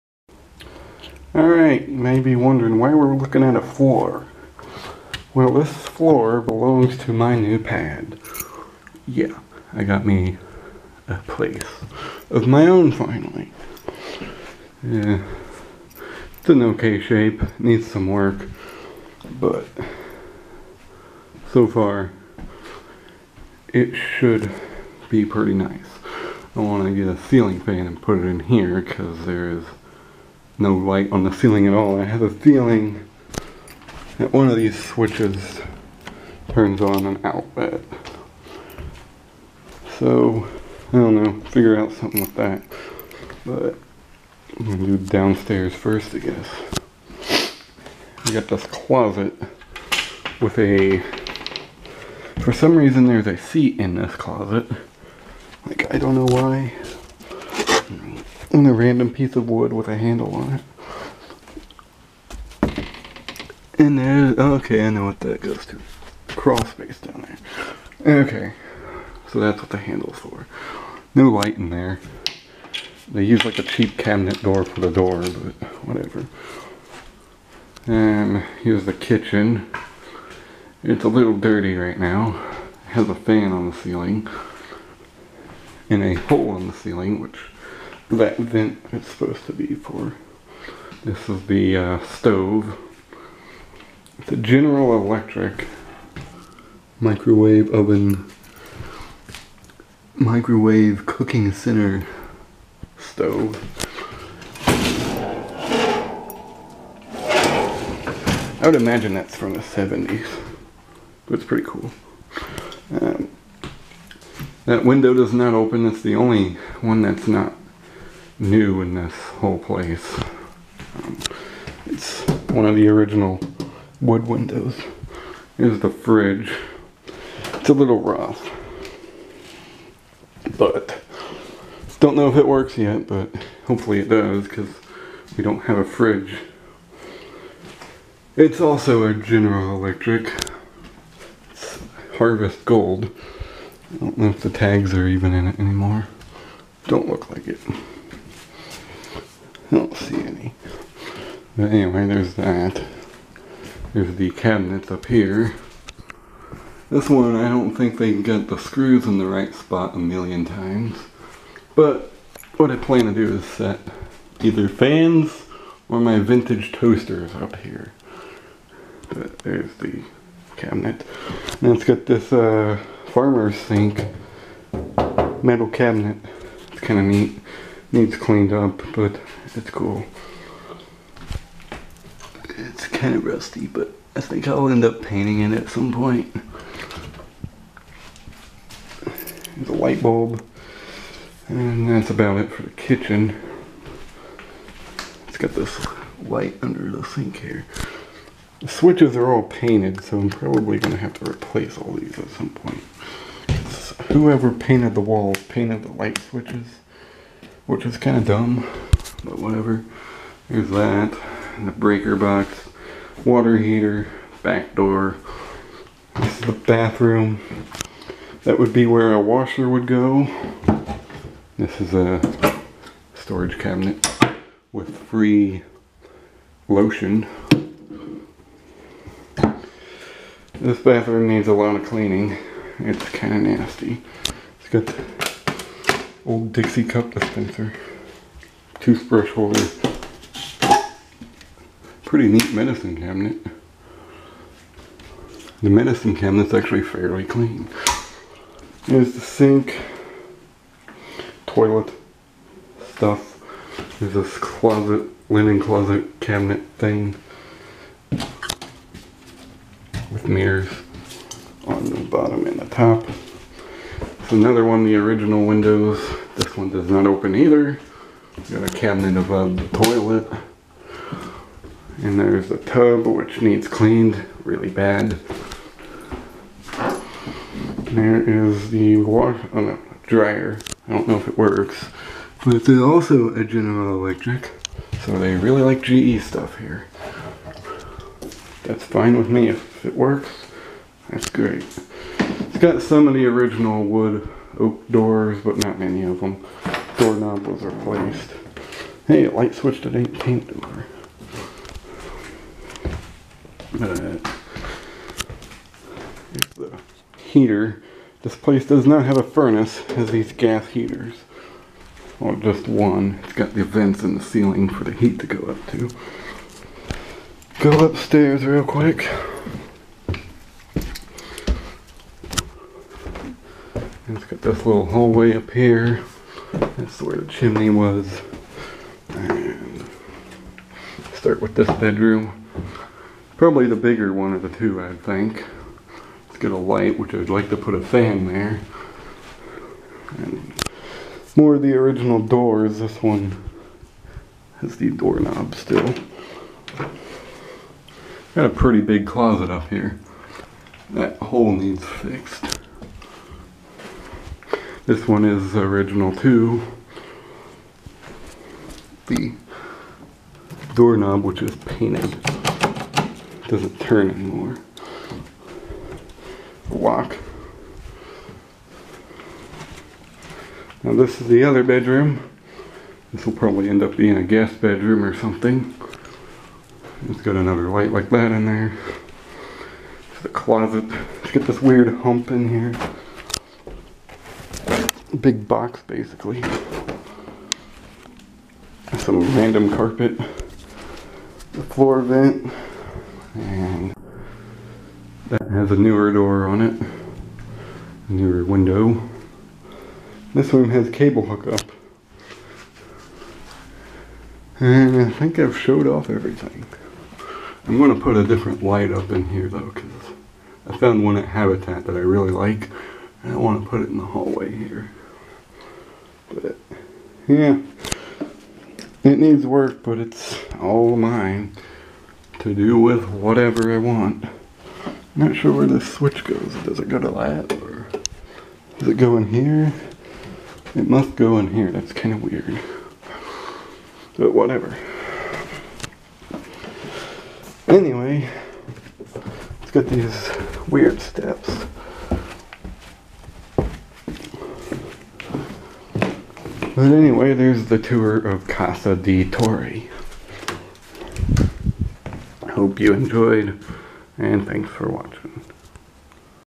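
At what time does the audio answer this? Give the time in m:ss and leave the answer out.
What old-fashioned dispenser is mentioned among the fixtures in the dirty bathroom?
3:56.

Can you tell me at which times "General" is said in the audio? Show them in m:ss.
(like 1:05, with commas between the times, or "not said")
1:34, 2:19, 4:43.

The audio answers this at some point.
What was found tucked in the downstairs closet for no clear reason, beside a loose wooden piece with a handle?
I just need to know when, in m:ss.
0:53.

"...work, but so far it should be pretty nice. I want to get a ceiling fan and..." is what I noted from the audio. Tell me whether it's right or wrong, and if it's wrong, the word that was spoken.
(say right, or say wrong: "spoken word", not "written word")
right.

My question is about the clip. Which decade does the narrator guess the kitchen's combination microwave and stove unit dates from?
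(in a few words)
The 70s.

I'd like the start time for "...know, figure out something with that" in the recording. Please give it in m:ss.
0:41.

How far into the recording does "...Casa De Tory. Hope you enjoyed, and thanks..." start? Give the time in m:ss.
7:28.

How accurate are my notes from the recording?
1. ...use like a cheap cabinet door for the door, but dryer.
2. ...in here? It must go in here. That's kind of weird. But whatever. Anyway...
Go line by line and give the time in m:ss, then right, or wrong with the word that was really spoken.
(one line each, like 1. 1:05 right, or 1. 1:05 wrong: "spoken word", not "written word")
1. 1:13 wrong: "whatever", not "dryer"
2. 7:09 right.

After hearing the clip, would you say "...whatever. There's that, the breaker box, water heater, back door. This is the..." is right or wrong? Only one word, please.
right.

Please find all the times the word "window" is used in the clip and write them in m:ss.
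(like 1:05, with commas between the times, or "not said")
1:54, 2:04, 4:25, 6:38.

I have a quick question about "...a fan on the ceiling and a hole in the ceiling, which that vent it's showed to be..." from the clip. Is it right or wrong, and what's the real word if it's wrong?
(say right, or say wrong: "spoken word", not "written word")
wrong: "supposed", not "showed".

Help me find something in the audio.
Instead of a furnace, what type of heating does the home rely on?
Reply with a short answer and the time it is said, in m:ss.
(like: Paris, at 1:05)
Gas heaters, at 5:10.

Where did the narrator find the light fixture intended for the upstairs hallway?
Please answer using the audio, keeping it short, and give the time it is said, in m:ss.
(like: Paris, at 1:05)
Habitat, at 6:51.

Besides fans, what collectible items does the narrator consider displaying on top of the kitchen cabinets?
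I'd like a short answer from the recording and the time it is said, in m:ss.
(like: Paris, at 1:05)
Vintage toasters, at 2:46.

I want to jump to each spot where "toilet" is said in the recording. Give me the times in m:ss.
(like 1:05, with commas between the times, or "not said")
4:11, 4:29.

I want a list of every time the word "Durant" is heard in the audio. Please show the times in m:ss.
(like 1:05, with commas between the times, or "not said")
not said.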